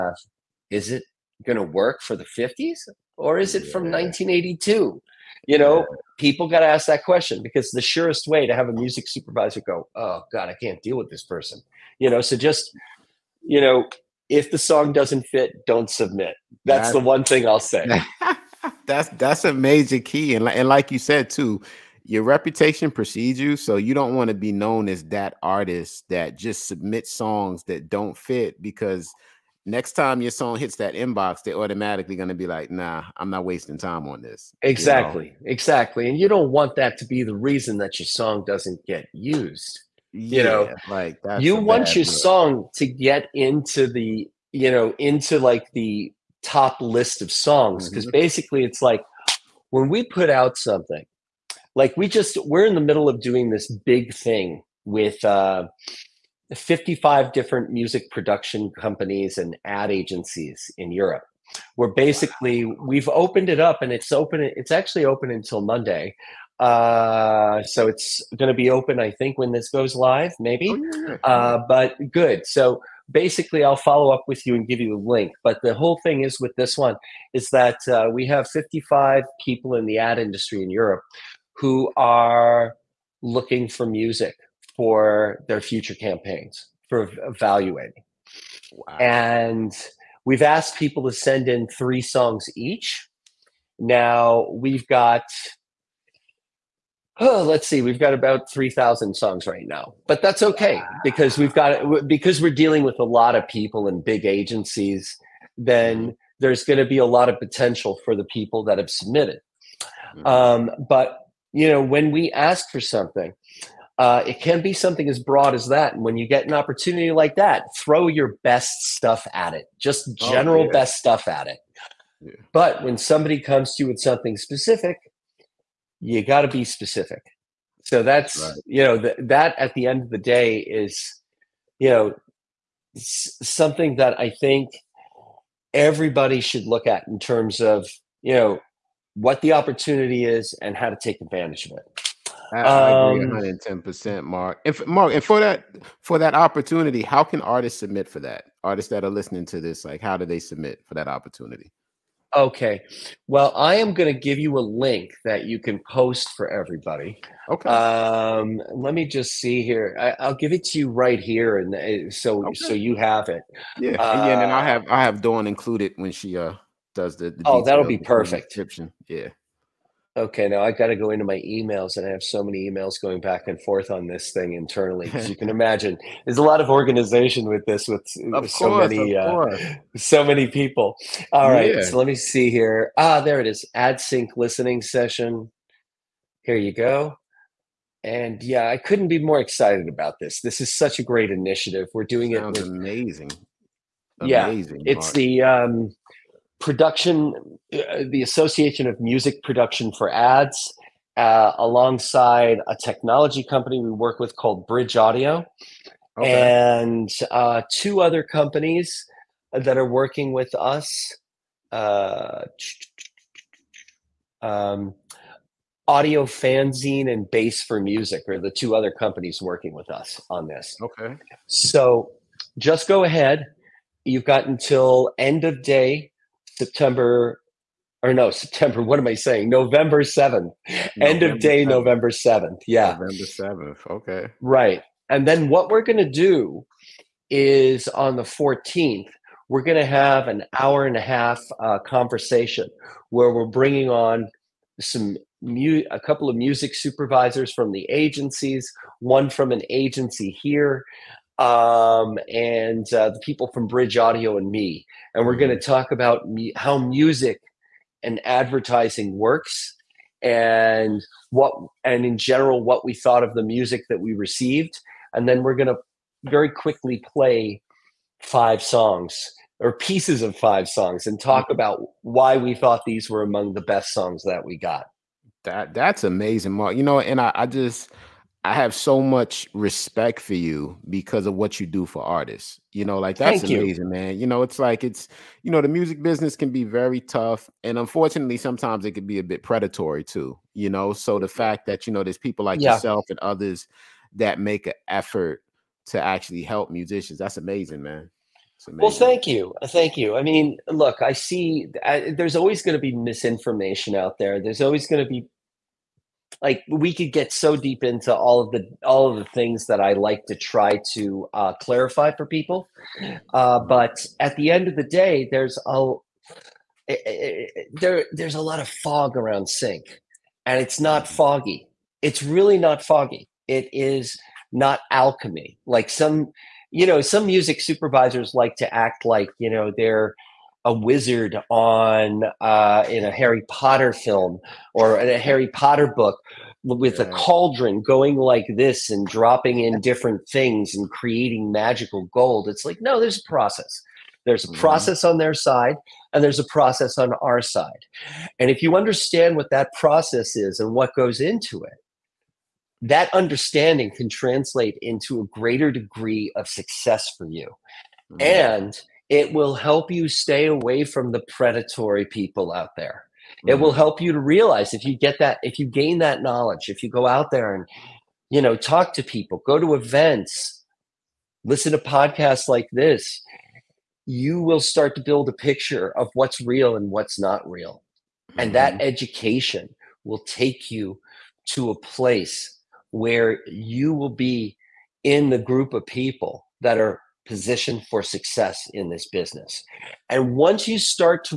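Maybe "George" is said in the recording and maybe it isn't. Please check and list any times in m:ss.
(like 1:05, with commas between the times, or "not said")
not said.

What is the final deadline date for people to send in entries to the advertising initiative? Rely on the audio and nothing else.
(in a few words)
November 7th.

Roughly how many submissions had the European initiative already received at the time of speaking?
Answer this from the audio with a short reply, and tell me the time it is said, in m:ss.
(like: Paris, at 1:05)
3,000, at 1:38.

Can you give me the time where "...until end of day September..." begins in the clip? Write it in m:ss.
3:44.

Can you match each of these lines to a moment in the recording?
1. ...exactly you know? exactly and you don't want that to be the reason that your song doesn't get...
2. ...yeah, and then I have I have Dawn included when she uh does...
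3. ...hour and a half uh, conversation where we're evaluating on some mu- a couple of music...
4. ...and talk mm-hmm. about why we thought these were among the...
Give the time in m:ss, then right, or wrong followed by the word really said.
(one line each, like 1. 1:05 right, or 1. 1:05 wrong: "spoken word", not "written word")
1. 0:34 right
2. 2:44 right
3. 4:00 wrong: "bringing", not "evaluating"
4. 4:31 right.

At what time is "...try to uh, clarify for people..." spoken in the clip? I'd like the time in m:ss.
5:10.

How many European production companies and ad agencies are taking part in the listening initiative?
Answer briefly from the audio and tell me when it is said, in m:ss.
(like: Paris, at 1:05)
55, at 0:56.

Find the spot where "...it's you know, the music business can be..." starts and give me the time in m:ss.
4:44.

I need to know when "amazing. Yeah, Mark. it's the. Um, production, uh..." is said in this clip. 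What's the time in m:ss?
3:14.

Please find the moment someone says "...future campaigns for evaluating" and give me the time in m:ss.
1:25.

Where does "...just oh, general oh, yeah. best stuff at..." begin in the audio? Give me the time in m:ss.
1:59.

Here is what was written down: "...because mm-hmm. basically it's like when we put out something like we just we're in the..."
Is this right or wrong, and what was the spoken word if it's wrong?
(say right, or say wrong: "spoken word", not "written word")
right.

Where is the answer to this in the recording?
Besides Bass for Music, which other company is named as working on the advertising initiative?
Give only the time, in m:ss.
3:35.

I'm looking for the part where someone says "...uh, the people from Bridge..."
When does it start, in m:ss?
4:12.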